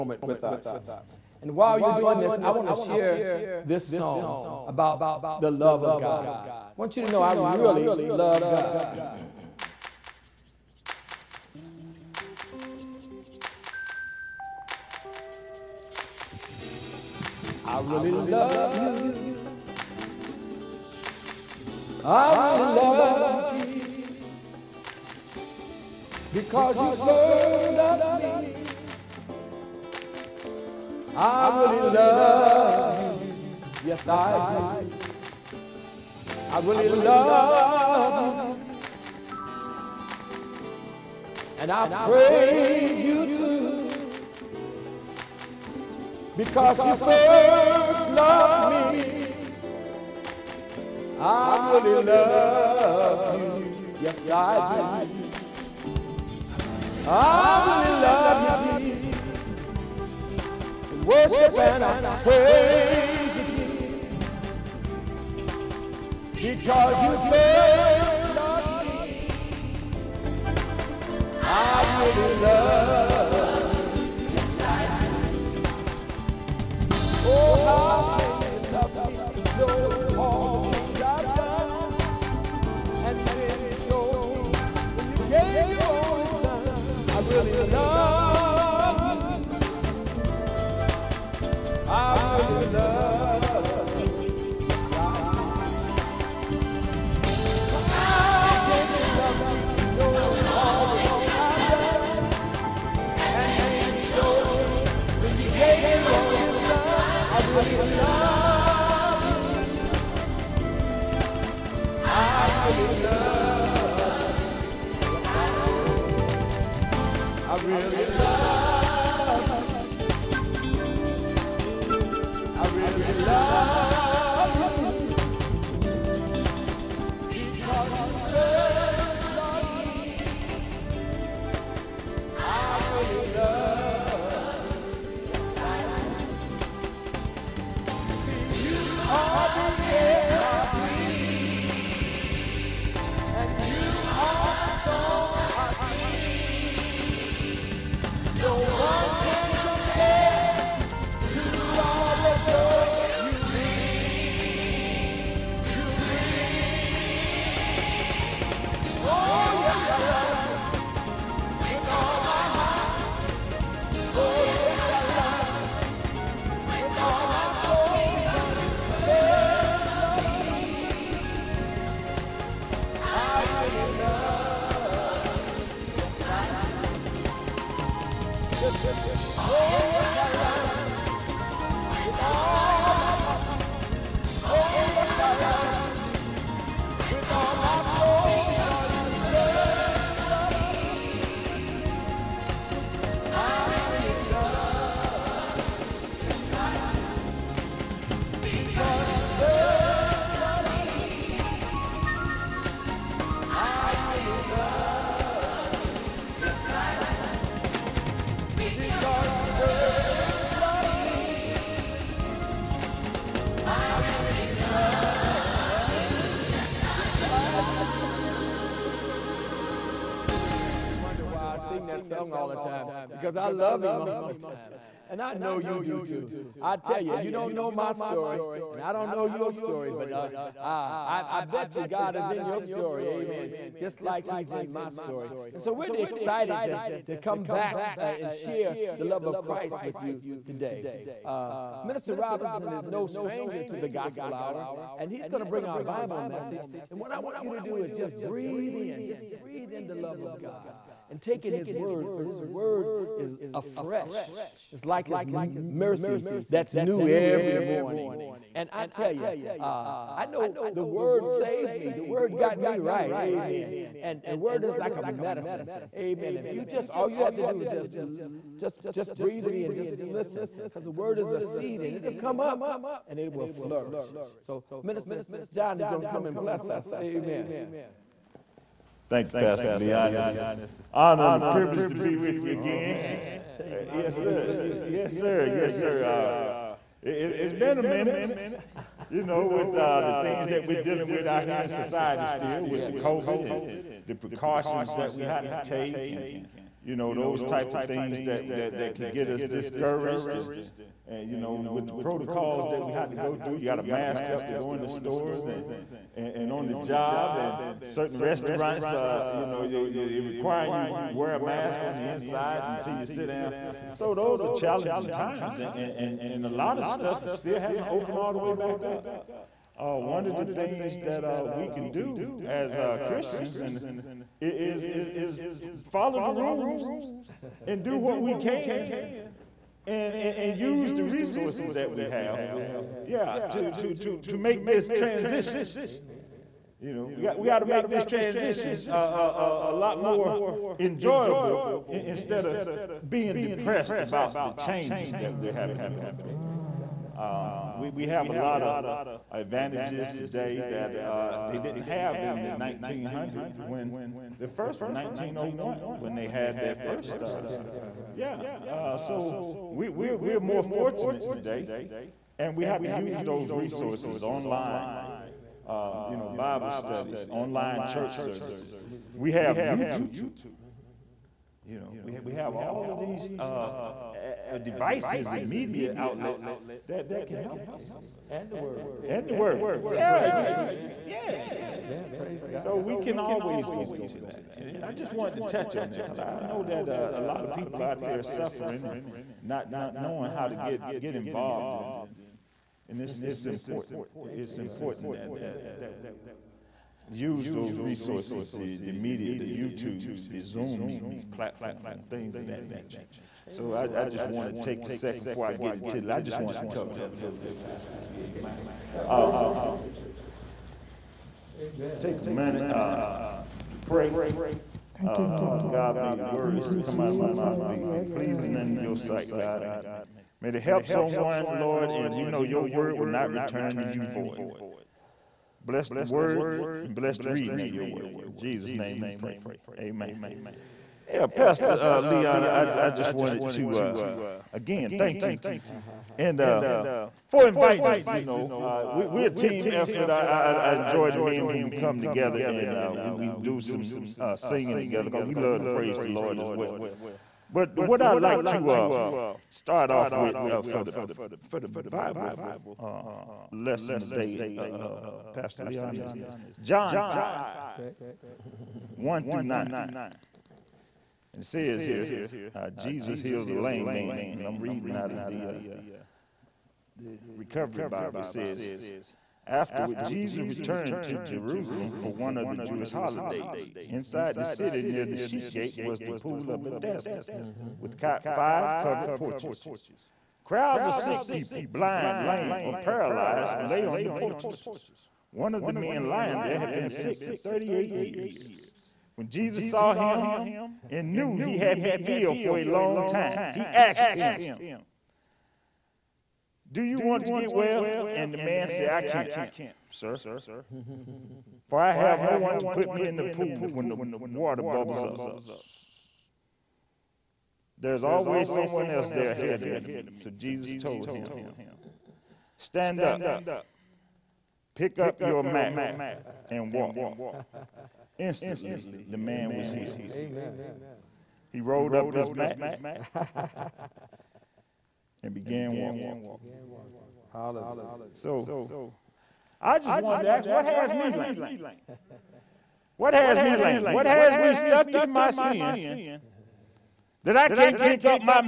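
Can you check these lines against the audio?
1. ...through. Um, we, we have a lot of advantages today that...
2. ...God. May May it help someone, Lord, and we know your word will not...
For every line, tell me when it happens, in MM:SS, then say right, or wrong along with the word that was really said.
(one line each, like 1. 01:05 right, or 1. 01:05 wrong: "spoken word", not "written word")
1. 05:46 right
2. 06:59 right.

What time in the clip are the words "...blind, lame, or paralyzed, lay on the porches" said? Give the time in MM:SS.
08:01.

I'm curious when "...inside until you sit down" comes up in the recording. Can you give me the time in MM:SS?
05:12.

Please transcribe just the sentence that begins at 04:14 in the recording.
It's like his mercy that's new every morning.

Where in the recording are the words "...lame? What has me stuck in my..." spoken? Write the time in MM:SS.
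08:53.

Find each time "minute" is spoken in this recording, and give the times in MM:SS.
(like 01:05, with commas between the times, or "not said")
04:47, 06:52.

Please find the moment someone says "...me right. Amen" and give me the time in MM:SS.
04:22.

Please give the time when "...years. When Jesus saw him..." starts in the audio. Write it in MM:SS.
08:07.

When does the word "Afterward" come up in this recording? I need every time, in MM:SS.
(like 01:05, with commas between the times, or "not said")
07:49.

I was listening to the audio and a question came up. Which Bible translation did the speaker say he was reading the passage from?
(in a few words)
Recovery Bible.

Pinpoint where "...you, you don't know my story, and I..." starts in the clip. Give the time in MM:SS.
03:47.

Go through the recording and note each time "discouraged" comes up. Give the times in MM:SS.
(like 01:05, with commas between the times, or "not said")
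04:59.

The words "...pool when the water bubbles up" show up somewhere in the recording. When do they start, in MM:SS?
08:23.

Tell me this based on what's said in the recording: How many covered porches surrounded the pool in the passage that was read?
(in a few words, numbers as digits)
5.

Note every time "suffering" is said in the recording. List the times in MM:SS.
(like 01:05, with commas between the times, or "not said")
06:28.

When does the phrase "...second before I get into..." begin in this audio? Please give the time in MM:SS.
06:44.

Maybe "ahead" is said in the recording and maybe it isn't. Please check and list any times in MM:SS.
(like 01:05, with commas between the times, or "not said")
08:29.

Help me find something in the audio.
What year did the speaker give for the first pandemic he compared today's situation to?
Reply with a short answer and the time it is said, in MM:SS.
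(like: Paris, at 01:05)
1901, at 05:54.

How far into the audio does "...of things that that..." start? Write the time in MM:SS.
04:57.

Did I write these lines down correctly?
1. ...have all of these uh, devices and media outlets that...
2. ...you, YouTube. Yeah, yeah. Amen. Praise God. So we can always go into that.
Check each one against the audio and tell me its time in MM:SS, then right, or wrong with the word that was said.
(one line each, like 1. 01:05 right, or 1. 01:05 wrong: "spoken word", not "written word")
1. 06:12 right
2. 06:20 wrong: "Amen", not "YouTube".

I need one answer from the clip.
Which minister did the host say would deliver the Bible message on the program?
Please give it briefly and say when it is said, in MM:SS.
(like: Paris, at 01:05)
Minister Robinson, at 04:01.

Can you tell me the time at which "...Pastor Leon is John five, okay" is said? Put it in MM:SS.
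07:35.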